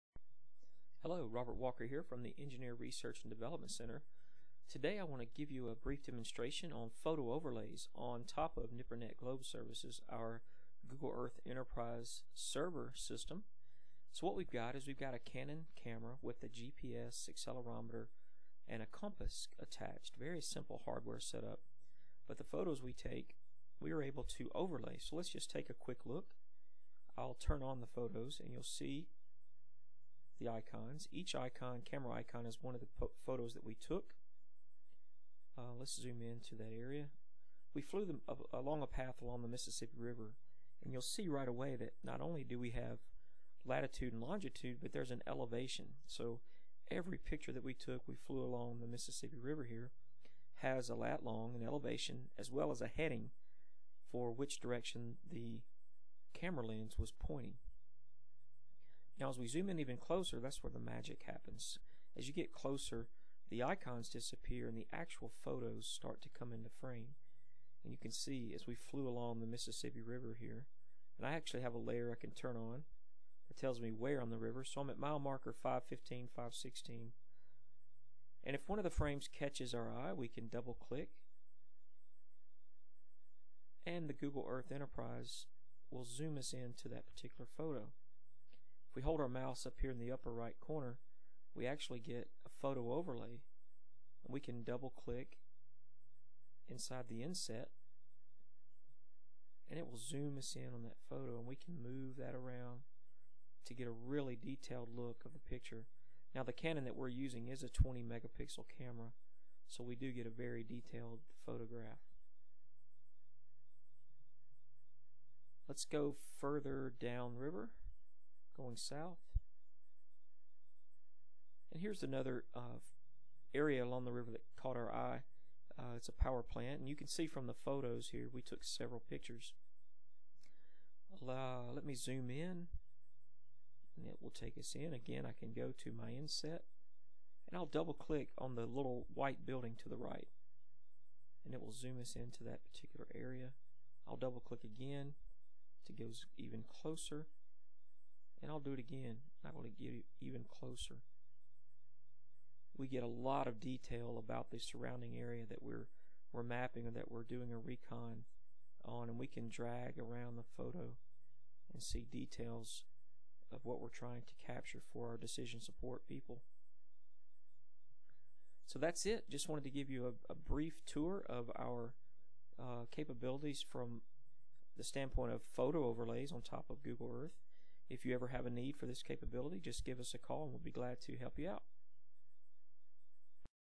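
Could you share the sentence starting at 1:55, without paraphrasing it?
Let's go further downriver going south.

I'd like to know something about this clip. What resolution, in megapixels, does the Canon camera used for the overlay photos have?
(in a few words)
20 megapixels.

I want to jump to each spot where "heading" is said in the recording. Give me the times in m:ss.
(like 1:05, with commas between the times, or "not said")
0:52.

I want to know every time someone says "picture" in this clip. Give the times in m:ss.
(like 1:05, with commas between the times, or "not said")
0:47, 1:45, 2:09.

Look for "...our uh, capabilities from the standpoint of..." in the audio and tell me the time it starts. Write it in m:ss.
2:51.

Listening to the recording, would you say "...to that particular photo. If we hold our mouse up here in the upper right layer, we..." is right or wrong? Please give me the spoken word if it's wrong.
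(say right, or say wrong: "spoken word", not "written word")
wrong: "corner", not "layer".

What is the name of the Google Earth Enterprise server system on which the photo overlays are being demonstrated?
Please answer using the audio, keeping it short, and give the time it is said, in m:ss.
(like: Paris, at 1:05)
NIPRNet Globe Services, at 0:08.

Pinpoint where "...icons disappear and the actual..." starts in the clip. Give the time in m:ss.
1:03.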